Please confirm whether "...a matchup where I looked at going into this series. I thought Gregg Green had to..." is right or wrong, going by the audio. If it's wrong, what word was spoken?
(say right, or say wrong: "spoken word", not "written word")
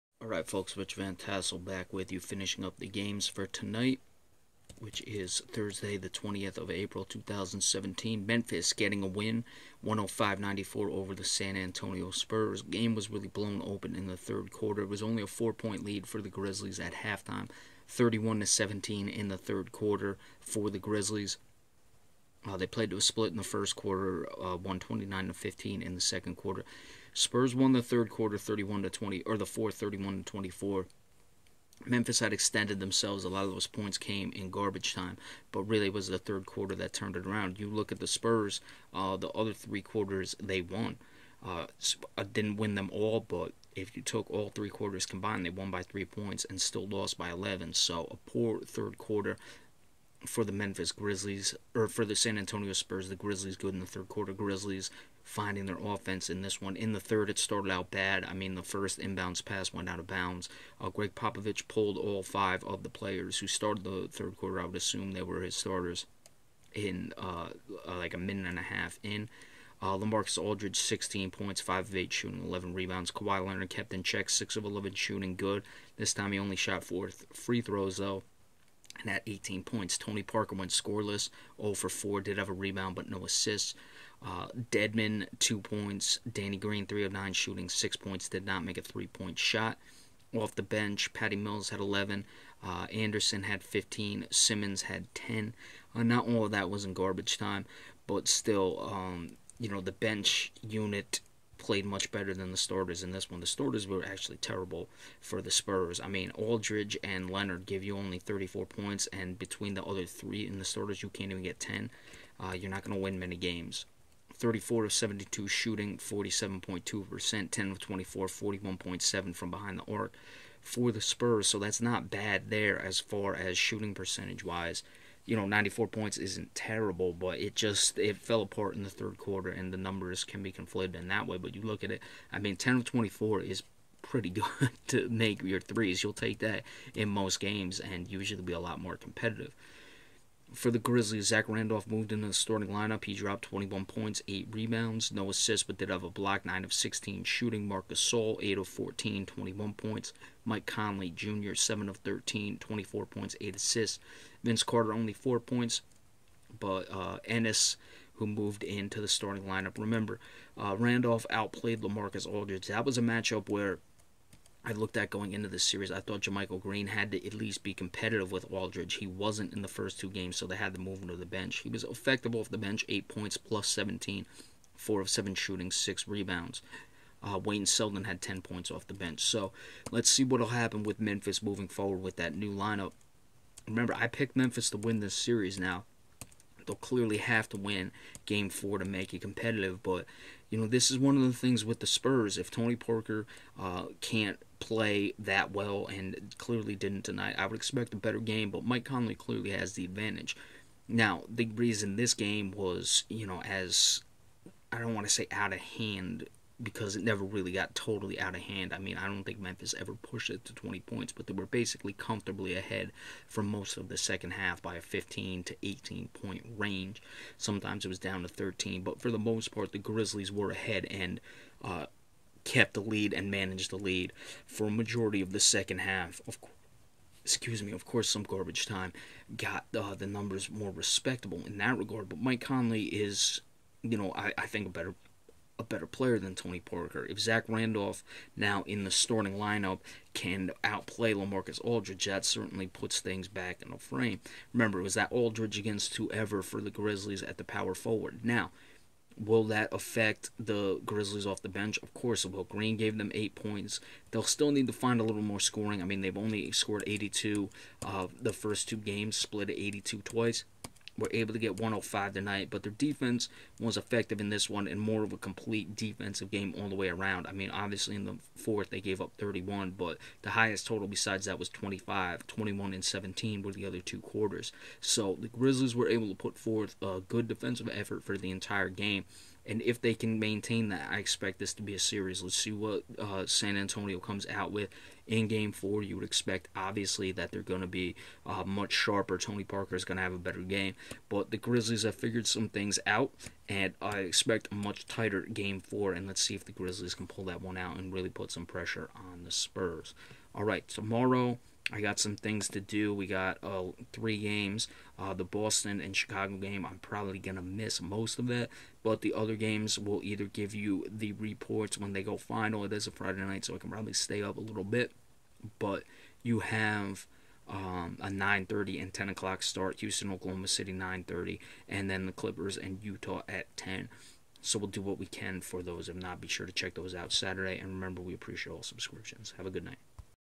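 wrong: "JaMychal", not "Gregg".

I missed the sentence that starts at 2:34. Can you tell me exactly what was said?
Vince Carter, only 4 points, but uh, Ennis, who moved into the starting lineup.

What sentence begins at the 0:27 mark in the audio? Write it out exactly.
Spurs won the third quarter 31 to 20 or the fourth 31 to 24.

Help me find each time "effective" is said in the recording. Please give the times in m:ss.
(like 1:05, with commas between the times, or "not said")
2:51, 4:23.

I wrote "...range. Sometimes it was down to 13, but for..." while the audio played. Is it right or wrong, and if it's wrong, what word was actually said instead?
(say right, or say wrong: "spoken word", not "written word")
right.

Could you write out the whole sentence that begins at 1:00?
Uh, Gregg Popovich pulled all five of the players who started the third quarter.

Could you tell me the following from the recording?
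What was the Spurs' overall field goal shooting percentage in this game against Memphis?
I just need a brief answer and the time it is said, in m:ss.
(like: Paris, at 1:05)
47.2%, at 1:55.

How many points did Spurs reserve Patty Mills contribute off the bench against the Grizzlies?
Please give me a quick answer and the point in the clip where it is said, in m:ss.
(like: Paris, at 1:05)
11, at 1:31.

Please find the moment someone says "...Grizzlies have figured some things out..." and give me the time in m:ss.
4:51.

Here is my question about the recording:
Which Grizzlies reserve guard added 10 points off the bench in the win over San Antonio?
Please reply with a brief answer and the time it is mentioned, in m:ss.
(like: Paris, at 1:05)
Wayne Selden, at 2:57.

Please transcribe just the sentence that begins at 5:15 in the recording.
But you have um, a 9.30 and 10 o'clock start.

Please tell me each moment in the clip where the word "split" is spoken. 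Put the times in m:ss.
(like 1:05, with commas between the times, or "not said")
0:23, 4:19.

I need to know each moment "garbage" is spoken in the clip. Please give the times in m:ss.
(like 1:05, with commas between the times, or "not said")
0:34, 1:36, 3:48.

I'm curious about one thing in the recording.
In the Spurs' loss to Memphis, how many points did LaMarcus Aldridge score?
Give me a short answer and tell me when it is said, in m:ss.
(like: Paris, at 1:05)
16, at 1:10.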